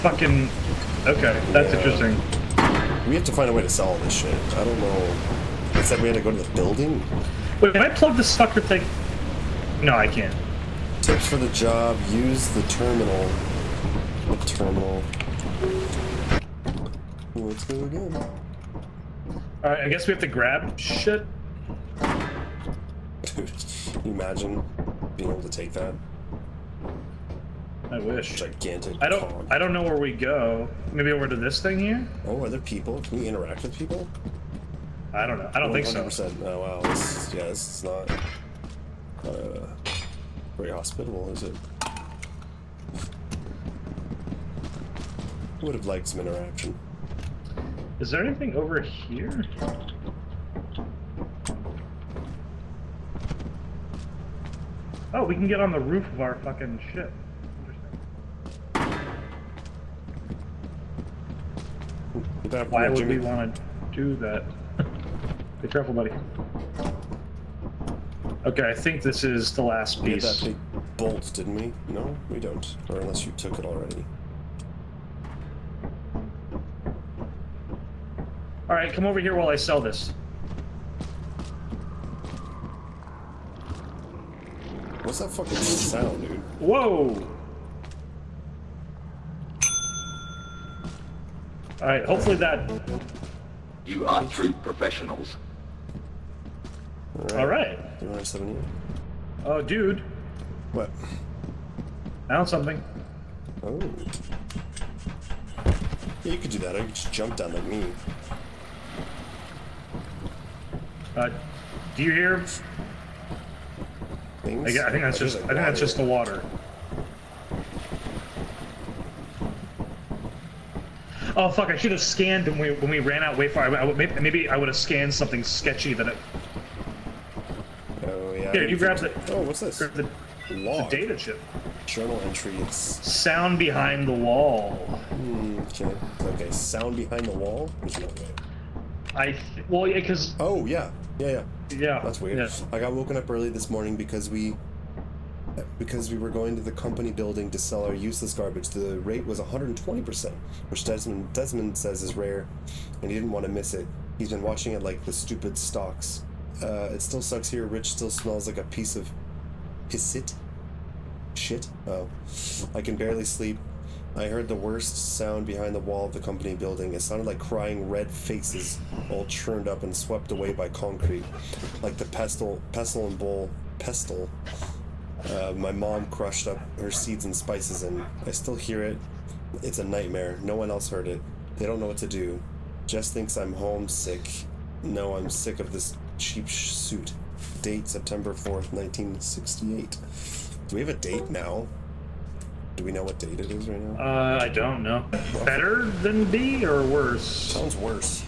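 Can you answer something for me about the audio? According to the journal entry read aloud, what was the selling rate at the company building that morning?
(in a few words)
120%.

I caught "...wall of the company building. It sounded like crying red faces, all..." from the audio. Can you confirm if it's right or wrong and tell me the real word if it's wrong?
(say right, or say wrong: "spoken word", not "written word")
right.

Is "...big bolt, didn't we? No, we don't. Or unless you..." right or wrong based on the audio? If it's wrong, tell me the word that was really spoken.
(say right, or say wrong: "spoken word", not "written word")
right.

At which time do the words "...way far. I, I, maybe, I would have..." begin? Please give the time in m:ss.
2:03.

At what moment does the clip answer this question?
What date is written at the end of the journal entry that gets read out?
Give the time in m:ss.
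3:07.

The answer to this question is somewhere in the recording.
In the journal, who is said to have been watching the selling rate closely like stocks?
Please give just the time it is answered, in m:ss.
2:30.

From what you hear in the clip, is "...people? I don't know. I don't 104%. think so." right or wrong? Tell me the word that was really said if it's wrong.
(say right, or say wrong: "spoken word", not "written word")
wrong: "100", not "104".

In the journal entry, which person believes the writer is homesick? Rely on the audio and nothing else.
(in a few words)
Jess.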